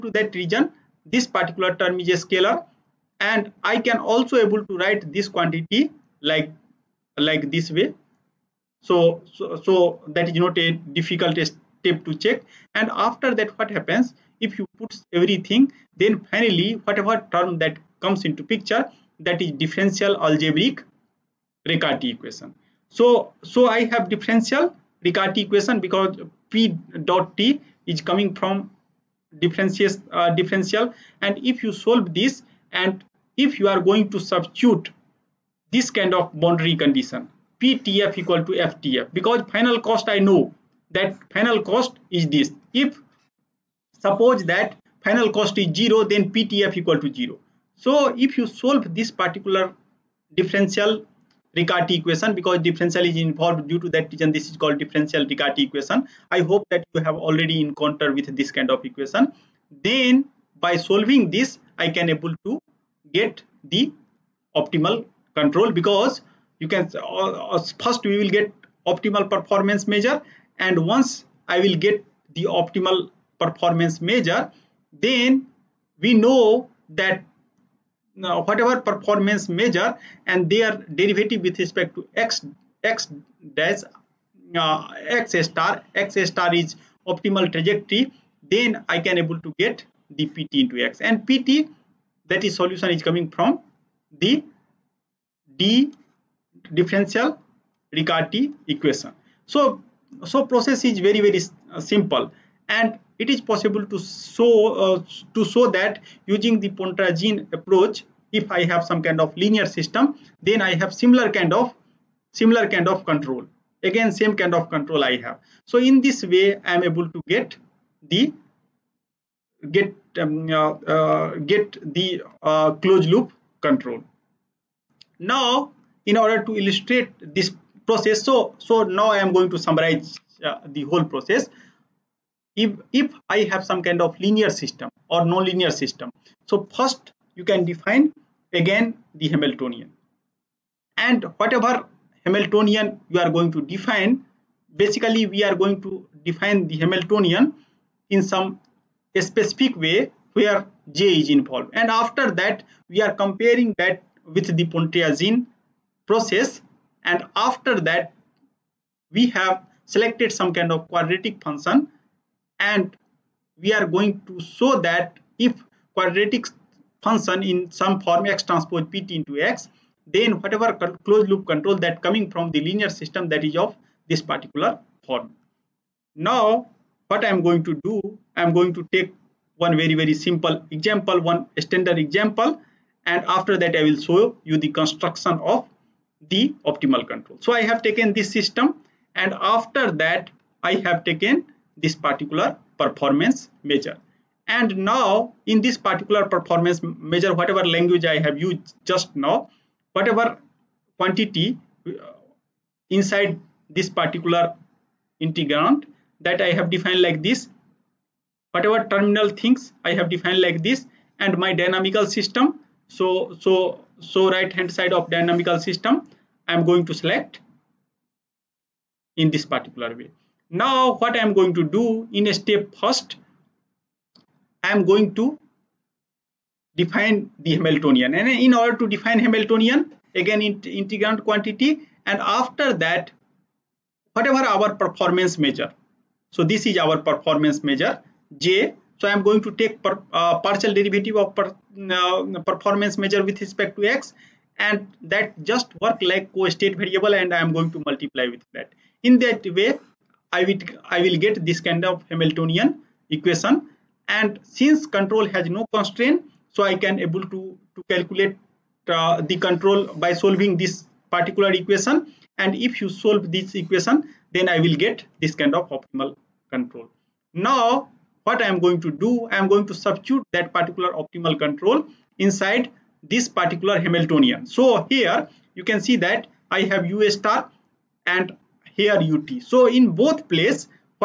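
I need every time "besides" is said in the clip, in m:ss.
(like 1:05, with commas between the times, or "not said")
not said.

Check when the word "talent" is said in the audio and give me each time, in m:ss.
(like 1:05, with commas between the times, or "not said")
not said.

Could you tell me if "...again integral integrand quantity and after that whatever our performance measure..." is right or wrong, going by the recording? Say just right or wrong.
right.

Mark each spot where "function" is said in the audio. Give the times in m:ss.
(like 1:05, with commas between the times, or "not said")
2:41, 2:47.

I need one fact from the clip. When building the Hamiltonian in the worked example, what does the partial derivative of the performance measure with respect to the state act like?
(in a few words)
co-state variable.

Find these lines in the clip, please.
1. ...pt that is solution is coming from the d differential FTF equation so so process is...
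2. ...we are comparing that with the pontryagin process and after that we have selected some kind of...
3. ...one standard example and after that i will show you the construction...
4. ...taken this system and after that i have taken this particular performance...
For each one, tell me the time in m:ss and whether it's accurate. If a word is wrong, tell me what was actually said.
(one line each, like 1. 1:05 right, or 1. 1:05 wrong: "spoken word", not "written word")
1. 1:31 wrong: "Riccati", not "FTF"
2. 2:32 right
3. 3:01 right
4. 3:07 right.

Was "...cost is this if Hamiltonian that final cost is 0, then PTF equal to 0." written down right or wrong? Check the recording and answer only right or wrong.
wrong.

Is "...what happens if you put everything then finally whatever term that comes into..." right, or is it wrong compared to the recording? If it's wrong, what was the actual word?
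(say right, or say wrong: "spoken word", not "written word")
right.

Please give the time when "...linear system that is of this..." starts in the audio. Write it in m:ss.
2:52.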